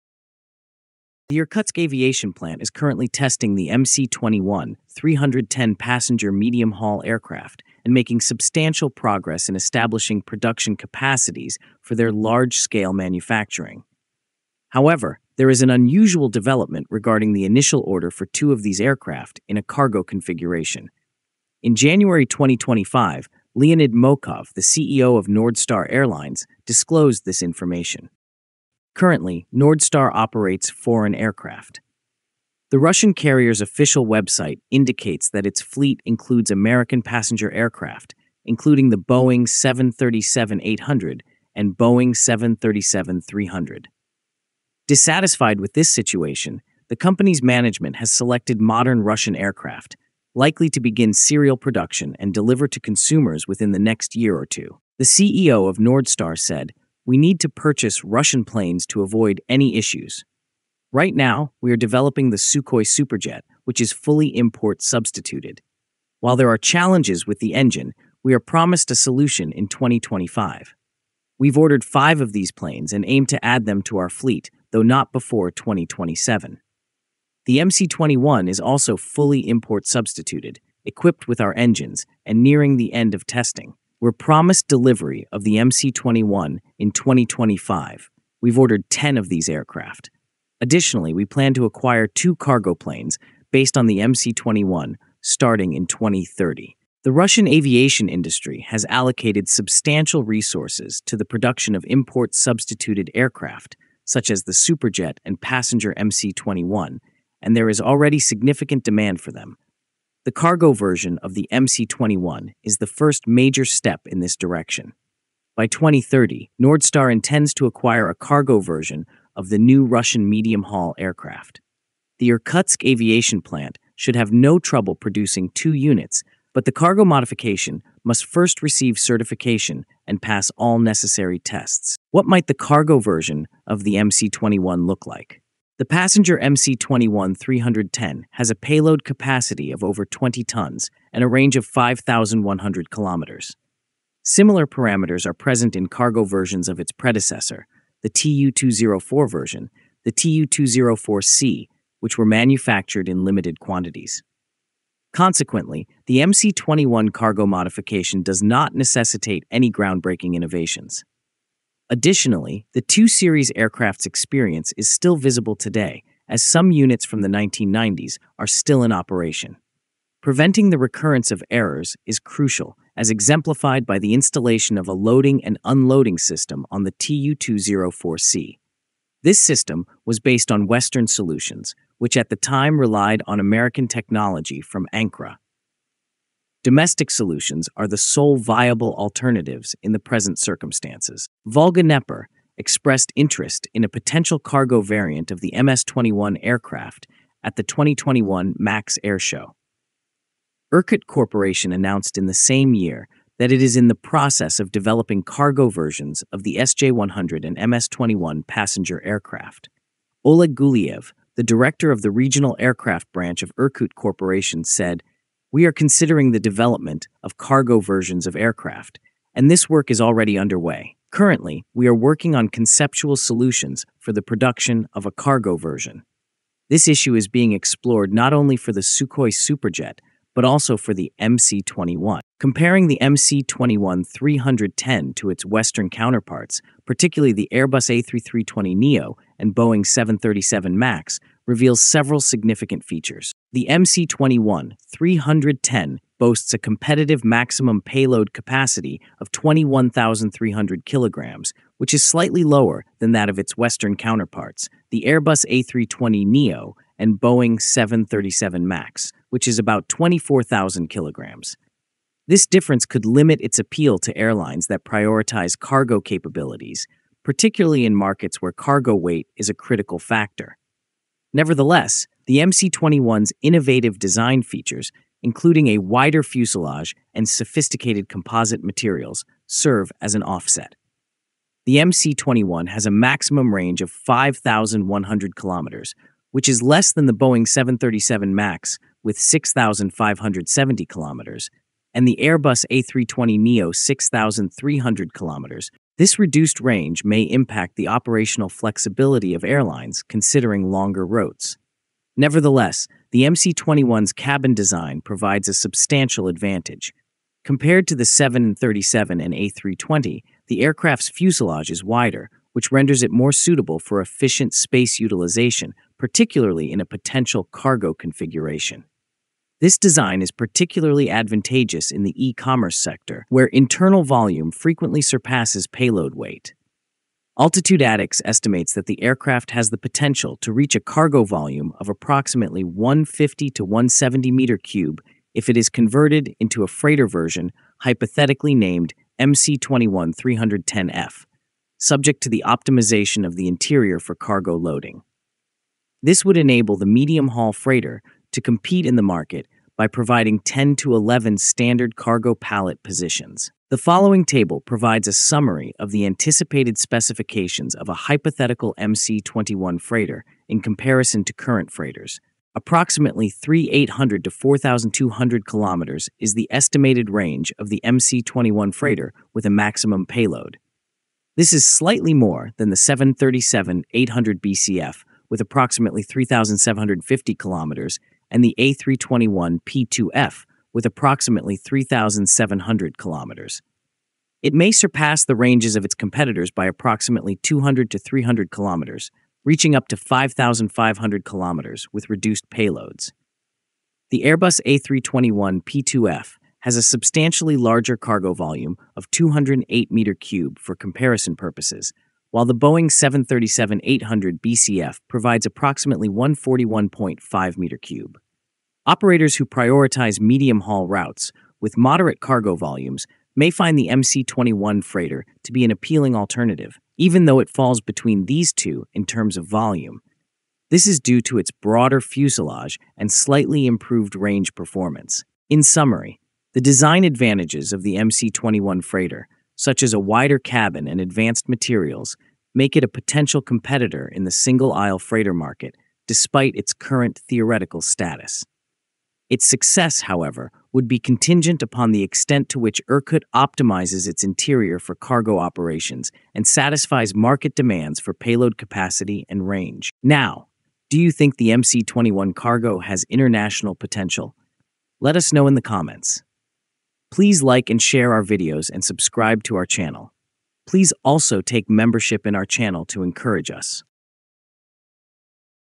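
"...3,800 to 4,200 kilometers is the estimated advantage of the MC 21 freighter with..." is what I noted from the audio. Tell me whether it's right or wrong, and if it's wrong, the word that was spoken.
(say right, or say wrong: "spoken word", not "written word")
wrong: "range", not "advantage".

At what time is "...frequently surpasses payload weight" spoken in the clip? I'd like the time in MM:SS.
05:24.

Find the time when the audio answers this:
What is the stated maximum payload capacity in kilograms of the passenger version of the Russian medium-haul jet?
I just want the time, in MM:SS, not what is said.
04:09.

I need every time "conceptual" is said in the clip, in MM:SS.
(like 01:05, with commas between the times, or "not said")
03:42.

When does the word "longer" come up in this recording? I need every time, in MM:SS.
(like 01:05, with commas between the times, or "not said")
05:00.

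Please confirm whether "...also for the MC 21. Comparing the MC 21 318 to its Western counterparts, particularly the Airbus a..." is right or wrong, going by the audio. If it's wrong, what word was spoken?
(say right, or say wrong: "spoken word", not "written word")
wrong: "310", not "318".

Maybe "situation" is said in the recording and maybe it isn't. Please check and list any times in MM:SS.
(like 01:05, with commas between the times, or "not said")
00:45.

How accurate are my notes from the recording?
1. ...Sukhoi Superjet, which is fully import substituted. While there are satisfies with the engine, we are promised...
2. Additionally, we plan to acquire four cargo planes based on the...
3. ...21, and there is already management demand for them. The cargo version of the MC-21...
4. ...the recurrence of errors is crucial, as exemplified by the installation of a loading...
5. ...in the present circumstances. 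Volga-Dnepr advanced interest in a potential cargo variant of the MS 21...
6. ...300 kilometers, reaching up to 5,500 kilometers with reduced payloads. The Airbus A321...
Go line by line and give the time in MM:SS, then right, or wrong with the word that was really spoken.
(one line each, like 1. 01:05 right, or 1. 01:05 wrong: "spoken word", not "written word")
1. 01:02 wrong: "challenges", not "satisfies"
2. 01:30 wrong: "two", not "four"
3. 01:46 wrong: "significant", not "management"
4. 02:50 right
5. 03:09 wrong: "expressed", not "advanced"
6. 06:27 right.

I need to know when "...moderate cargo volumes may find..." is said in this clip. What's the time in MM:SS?
06:51.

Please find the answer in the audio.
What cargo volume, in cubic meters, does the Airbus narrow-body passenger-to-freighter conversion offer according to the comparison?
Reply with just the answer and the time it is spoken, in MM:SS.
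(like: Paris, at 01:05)
208 cubic meters, at 06:39.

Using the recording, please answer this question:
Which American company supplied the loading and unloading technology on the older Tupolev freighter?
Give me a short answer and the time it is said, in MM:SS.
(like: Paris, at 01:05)
Ancra, at 03:04.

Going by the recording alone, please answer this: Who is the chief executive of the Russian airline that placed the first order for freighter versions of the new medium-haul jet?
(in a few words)
Leonid Mokhov.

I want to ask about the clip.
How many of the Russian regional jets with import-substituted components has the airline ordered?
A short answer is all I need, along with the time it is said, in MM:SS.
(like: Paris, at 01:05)
5, at 01:11.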